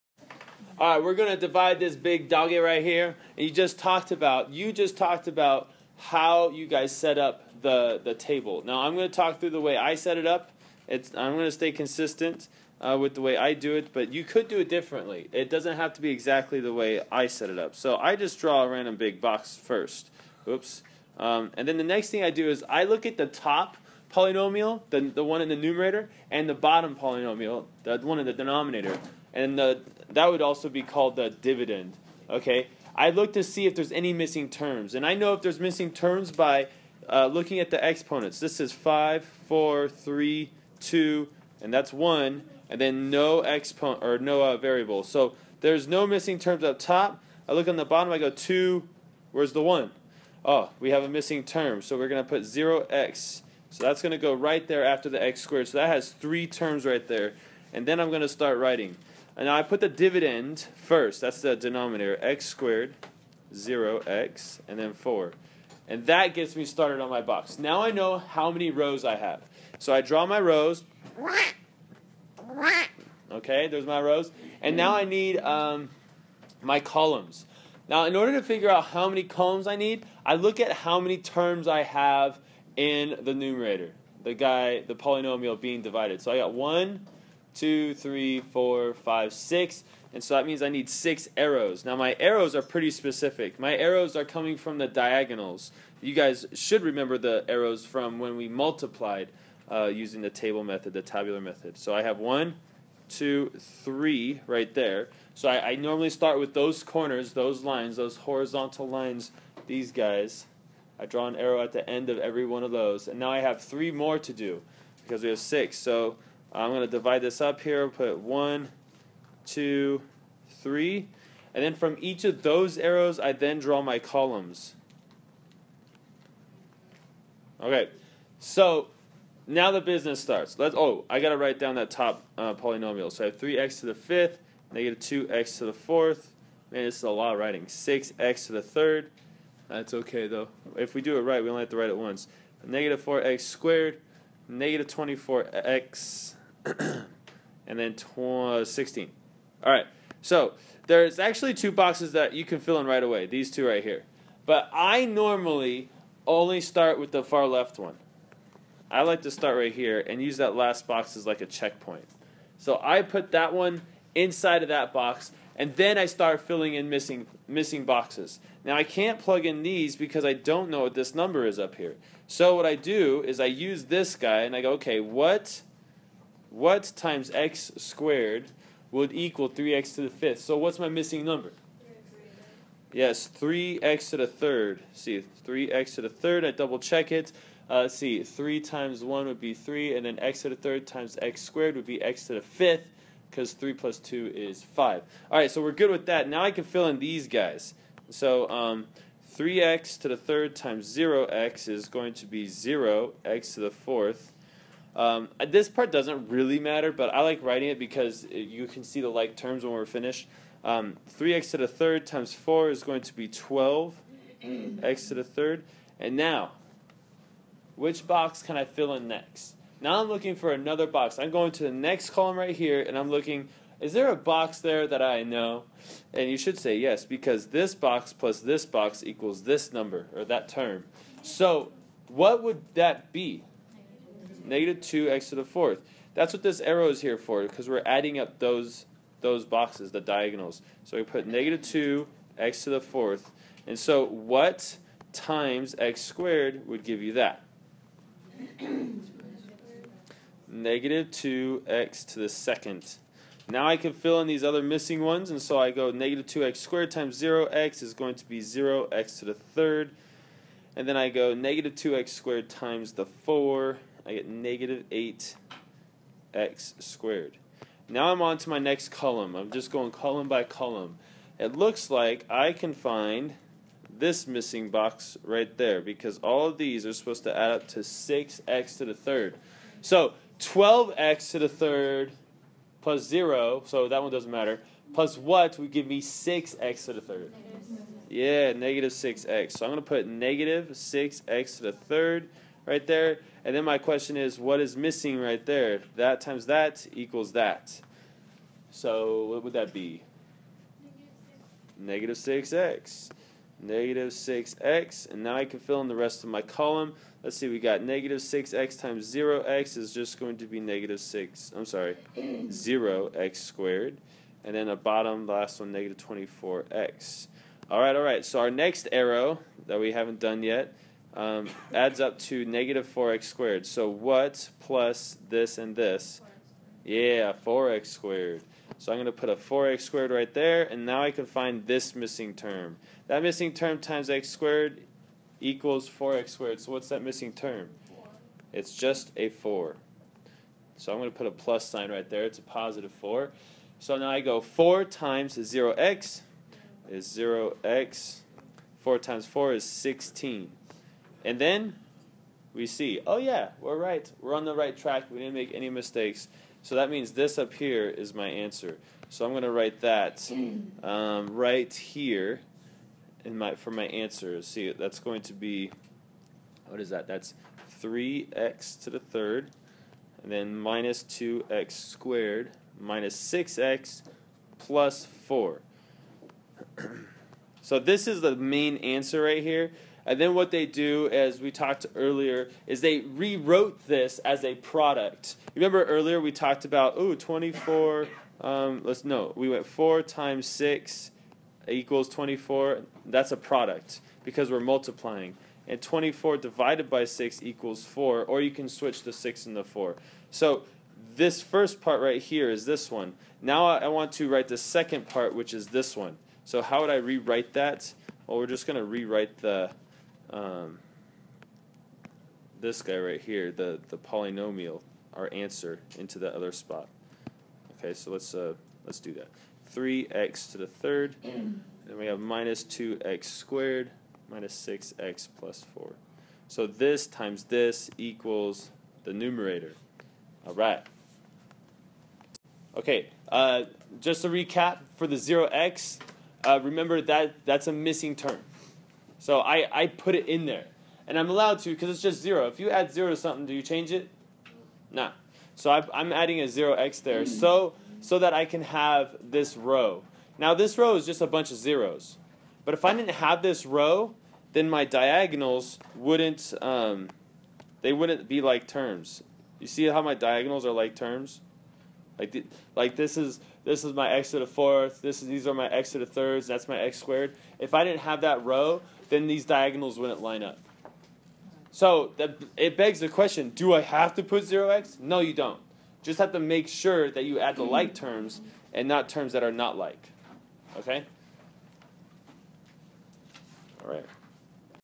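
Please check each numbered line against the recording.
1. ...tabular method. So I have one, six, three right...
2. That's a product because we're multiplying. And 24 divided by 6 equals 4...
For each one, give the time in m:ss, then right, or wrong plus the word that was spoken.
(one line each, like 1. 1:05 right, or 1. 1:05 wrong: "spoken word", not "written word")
1. 1:41 wrong: "two", not "six"
2. 6:33 right.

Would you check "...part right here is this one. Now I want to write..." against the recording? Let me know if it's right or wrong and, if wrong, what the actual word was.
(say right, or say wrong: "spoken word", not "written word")
right.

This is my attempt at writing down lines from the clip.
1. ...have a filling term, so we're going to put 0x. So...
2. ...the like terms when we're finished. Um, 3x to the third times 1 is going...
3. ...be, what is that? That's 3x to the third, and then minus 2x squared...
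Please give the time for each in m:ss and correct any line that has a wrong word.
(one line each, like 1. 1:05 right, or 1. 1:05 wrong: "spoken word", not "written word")
1. 0:50 wrong: "missing", not "filling"
2. 3:29 wrong: "4", not "1"
3. 6:05 right.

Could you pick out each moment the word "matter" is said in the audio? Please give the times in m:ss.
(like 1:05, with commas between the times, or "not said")
3:26, 4:44.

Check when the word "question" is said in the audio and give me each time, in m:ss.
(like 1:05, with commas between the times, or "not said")
4:53, 7:53.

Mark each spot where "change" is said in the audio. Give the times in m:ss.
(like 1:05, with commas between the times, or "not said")
7:23.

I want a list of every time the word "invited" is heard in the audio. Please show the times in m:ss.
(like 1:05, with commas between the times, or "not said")
not said.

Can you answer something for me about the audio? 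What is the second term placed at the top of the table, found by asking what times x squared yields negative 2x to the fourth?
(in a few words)
negative 2x squared.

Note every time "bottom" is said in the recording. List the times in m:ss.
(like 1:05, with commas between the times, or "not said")
0:26, 0:47, 5:14.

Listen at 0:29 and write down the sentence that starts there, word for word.
And the that would also be called the dividend.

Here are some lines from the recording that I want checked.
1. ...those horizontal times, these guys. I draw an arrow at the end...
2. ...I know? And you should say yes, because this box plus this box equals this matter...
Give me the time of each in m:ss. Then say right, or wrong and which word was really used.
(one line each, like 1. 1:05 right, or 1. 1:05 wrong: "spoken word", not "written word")
1. 1:47 wrong: "lines", not "times"
2. 3:45 wrong: "number", not "matter".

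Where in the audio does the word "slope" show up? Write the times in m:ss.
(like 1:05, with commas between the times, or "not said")
not said.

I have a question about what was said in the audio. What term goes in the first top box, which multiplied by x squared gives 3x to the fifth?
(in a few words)
3x to the third.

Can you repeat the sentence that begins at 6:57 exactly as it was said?
Okay, so let's uh, let's do that.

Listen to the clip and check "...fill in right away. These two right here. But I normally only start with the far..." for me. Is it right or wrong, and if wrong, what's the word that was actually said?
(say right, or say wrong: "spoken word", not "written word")
right.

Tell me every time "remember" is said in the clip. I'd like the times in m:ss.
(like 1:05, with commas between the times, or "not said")
1:36, 6:25, 7:16.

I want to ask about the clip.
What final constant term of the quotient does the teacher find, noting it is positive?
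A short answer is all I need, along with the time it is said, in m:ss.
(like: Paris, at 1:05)
4, at 5:38.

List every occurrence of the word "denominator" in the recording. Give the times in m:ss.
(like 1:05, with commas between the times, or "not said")
0:28, 1:01.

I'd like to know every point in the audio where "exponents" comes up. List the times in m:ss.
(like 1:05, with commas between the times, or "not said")
0:37, 0:43.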